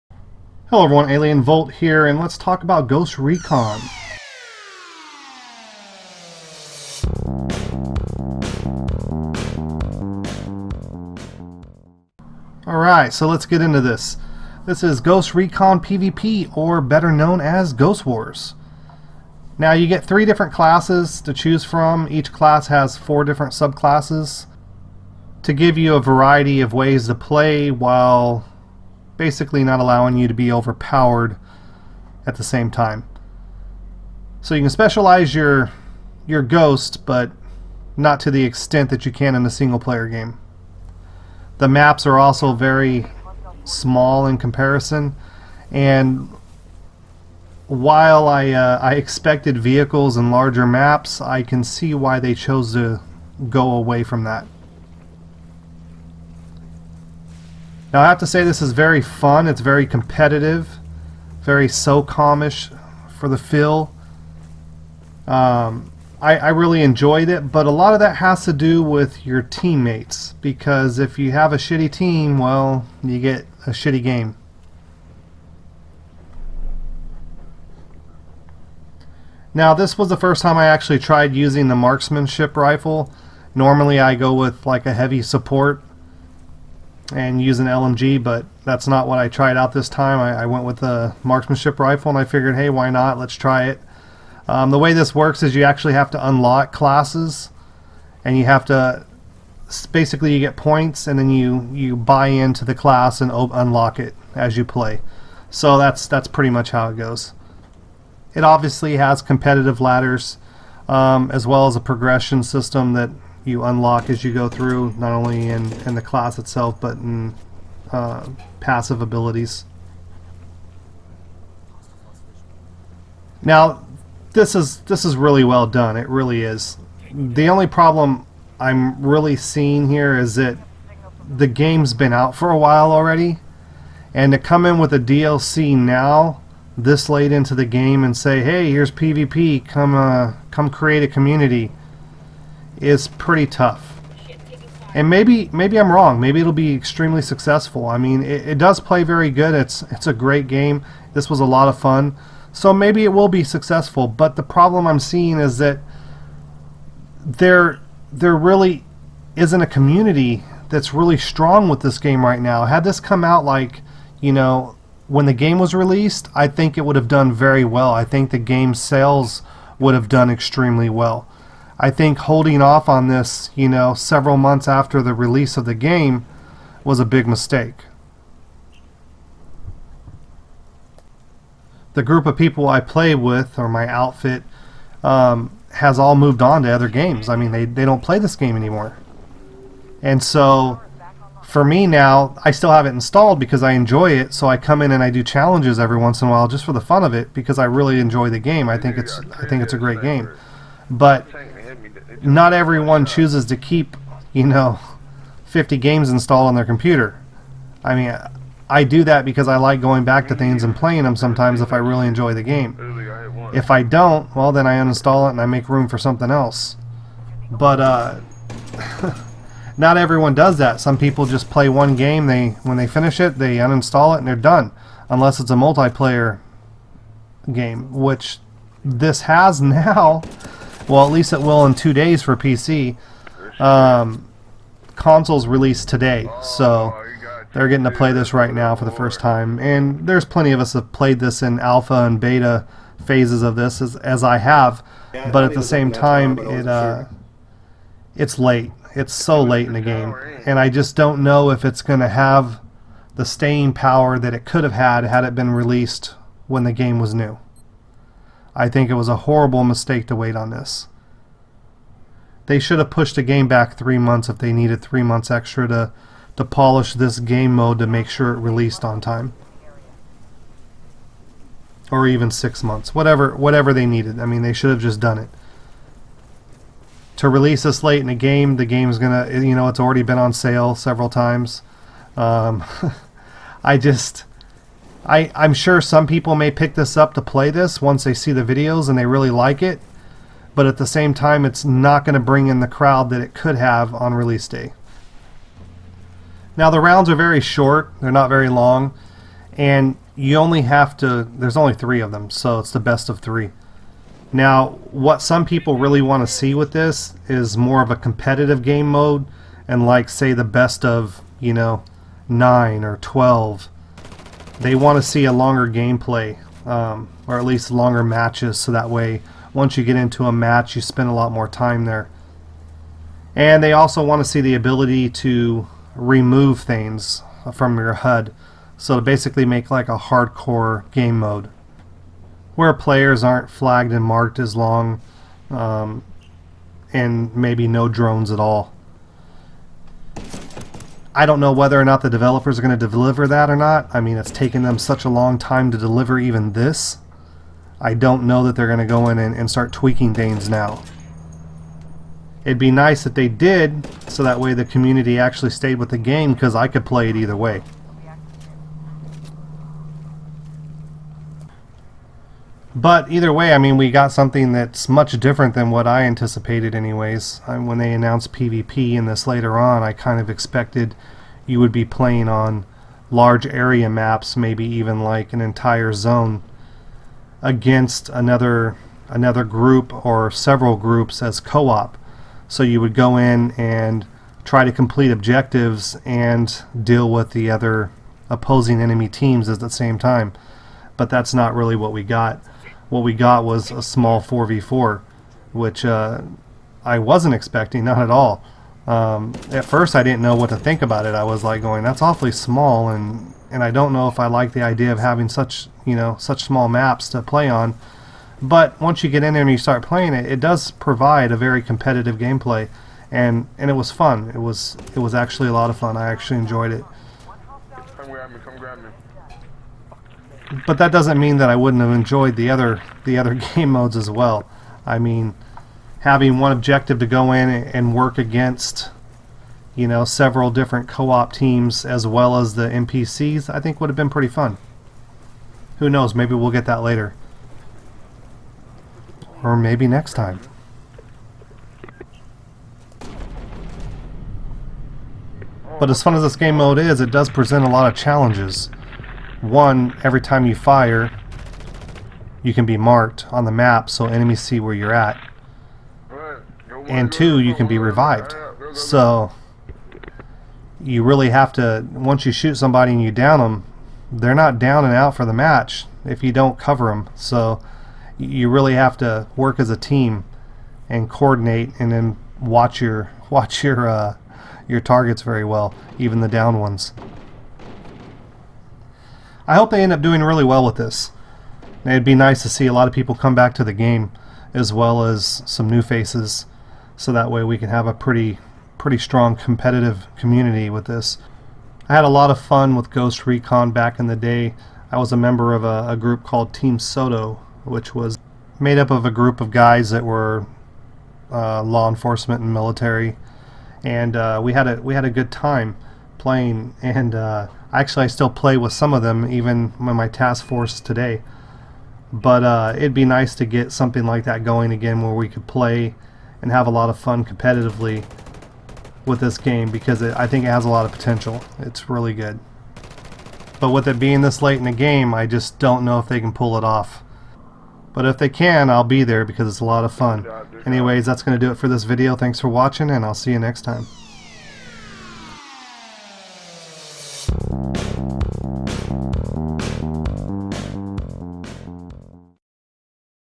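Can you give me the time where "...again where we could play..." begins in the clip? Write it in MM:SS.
08:34.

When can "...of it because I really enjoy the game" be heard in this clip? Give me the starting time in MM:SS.
03:17.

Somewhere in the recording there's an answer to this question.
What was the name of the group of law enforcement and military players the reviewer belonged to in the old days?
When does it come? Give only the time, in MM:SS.
08:16.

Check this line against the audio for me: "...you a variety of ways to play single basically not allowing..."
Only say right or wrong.
wrong.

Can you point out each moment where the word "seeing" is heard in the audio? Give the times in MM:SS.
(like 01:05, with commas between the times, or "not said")
02:09, 02:34.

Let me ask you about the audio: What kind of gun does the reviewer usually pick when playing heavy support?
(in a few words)
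LMG.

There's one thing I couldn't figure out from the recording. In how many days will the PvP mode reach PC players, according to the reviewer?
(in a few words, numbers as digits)
2.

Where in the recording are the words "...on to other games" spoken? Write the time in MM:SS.
03:06.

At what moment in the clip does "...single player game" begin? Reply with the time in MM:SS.
00:39.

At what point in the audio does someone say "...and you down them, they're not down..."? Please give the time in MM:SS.
07:42.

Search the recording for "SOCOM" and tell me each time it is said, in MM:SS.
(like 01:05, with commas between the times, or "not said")
01:01.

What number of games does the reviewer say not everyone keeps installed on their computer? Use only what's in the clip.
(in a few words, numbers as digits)
50.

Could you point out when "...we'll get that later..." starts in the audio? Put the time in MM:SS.
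07:16.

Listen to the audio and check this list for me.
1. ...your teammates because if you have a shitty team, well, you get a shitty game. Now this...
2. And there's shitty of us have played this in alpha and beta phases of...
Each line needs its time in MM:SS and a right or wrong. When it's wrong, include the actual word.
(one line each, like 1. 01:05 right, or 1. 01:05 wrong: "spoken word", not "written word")
1. 01:09 right
2. 03:59 wrong: "plenty", not "shitty".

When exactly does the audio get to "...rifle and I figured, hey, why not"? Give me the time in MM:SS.
01:31.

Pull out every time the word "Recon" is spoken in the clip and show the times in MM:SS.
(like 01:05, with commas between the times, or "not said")
00:03, 00:15, 08:13.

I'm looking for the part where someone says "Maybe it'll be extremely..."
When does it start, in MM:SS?
02:26.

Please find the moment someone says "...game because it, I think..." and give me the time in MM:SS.
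08:39.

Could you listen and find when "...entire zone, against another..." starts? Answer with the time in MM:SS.
06:15.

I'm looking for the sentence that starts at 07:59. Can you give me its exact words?
I hope they end up doing really well with this.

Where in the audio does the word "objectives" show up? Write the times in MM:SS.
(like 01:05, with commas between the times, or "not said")
06:25, 07:06.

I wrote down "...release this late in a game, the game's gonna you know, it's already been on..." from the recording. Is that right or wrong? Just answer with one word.
right.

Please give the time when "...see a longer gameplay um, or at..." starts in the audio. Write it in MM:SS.
05:15.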